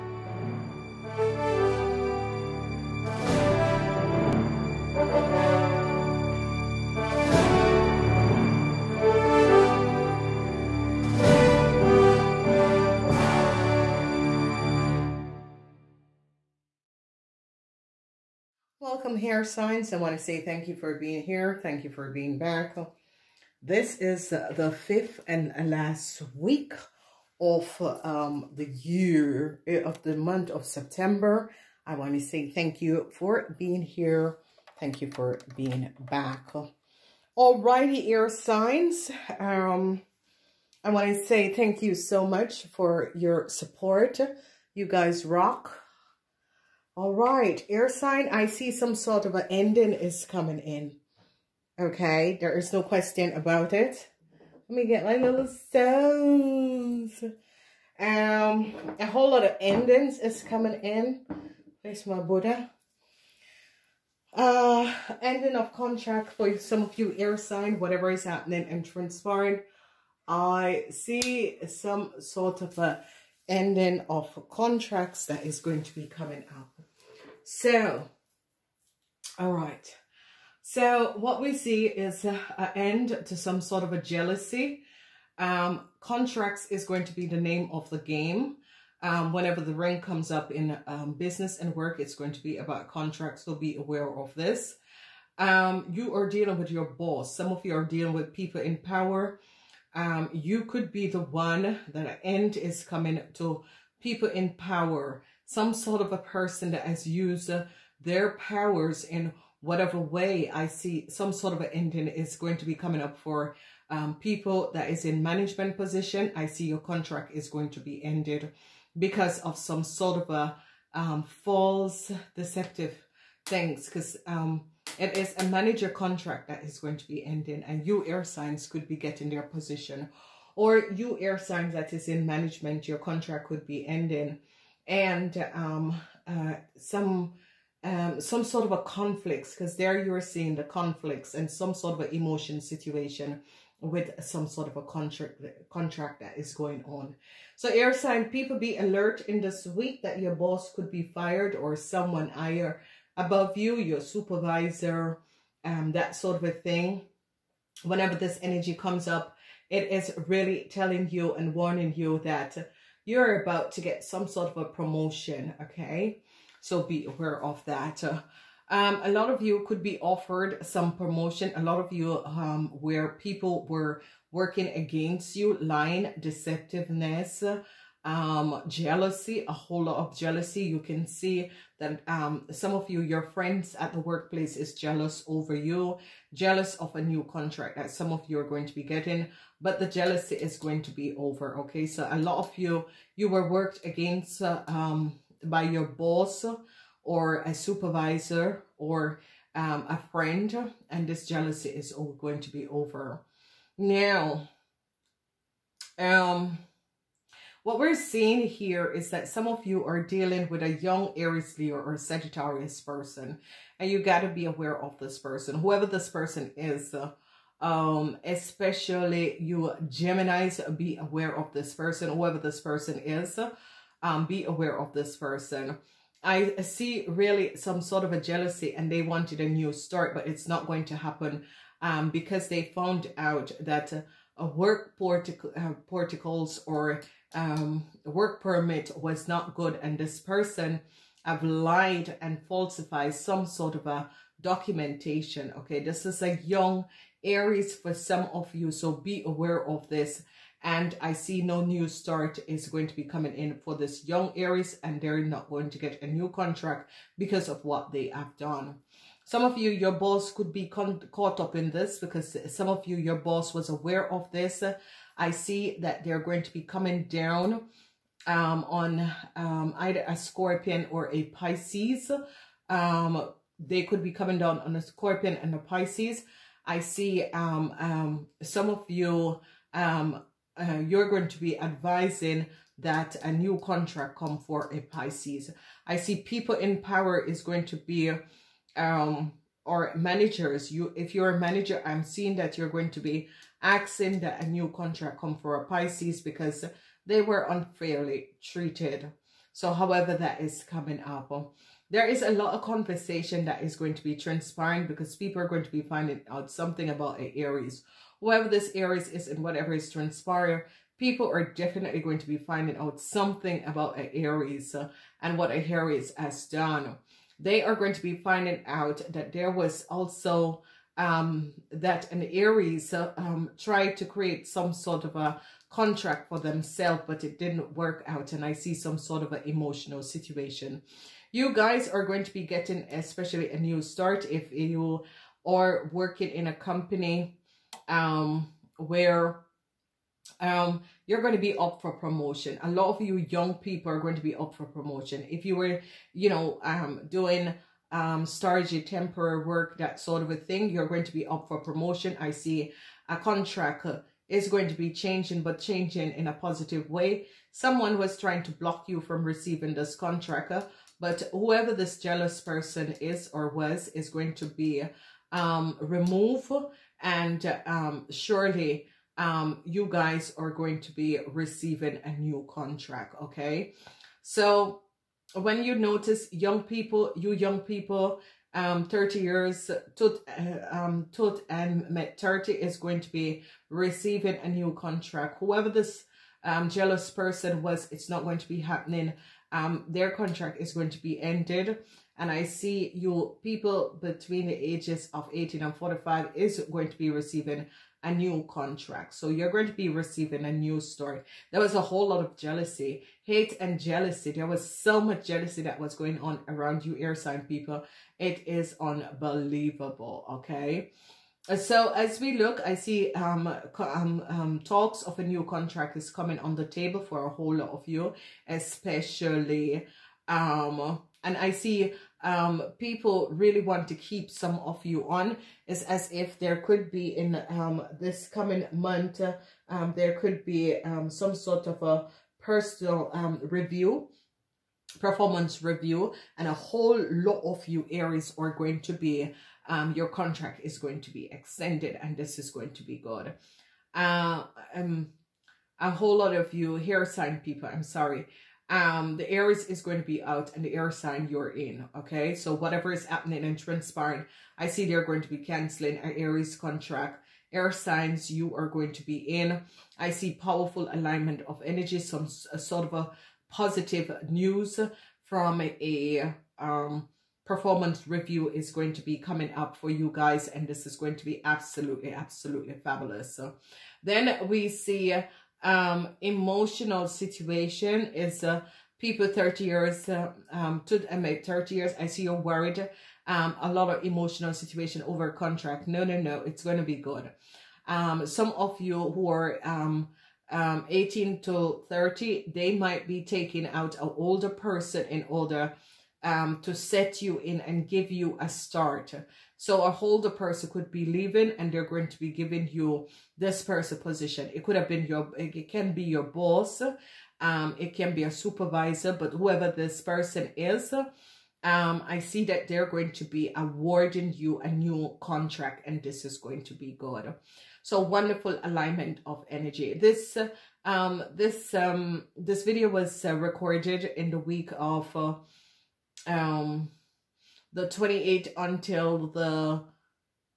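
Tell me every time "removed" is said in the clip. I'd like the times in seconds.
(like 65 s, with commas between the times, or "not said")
365 s.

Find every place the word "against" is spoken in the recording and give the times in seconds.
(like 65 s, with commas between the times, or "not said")
174 s, 193 s.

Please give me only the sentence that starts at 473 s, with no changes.
So then we see um, emotional situation is uh, people 30 years uh, um, to I mean, 30 years.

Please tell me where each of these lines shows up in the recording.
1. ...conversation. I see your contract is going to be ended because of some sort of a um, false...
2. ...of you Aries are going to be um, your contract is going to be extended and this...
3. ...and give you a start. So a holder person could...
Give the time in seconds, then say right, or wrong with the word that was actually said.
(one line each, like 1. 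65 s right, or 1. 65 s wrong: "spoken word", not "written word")
1. 115 s wrong: "position", not "conversation"
2. 437 s right
3. 497 s right.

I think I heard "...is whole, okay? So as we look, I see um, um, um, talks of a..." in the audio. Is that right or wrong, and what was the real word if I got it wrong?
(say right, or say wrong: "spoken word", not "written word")
wrong: "unbelievable", not "whole".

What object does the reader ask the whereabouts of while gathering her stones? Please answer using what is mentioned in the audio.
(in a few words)
Buddha.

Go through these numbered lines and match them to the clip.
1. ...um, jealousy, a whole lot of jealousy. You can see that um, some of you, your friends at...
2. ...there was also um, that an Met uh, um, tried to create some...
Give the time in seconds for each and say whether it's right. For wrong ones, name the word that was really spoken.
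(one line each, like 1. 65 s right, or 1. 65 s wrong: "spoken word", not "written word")
1. 178 s right
2. 319 s wrong: "Aries", not "Met".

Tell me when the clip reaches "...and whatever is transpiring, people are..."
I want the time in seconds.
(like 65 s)
309 s.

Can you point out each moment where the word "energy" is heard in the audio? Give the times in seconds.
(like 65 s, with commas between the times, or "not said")
158 s, 461 s, 519 s.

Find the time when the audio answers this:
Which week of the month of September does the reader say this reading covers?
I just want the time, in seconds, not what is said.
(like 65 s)
24 s.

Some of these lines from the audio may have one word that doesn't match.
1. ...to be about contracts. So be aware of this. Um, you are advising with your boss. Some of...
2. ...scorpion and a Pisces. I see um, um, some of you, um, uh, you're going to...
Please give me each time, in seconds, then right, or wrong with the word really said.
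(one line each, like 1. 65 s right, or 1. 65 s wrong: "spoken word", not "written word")
1. 92 s wrong: "dealing", not "advising"
2. 274 s right.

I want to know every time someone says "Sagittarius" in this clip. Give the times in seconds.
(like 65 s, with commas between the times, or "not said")
211 s.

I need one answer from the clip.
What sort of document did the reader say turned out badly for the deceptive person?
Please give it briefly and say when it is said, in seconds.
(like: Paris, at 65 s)
Work permit, at 238 s.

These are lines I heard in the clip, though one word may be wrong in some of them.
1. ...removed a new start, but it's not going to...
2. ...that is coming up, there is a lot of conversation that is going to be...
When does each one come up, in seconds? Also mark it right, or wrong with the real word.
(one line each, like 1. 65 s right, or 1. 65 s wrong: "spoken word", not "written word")
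1. 229 s wrong: "wanted", not "removed"
2. 300 s right.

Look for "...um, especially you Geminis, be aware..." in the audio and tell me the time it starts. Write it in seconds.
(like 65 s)
217 s.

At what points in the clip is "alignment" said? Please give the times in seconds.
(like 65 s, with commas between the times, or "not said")
460 s, 518 s.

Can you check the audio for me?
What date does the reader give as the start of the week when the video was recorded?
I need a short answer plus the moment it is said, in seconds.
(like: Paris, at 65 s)
28th, at 527 s.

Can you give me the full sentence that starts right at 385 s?
Whoever this um, jealous person was, it's not going to be happening.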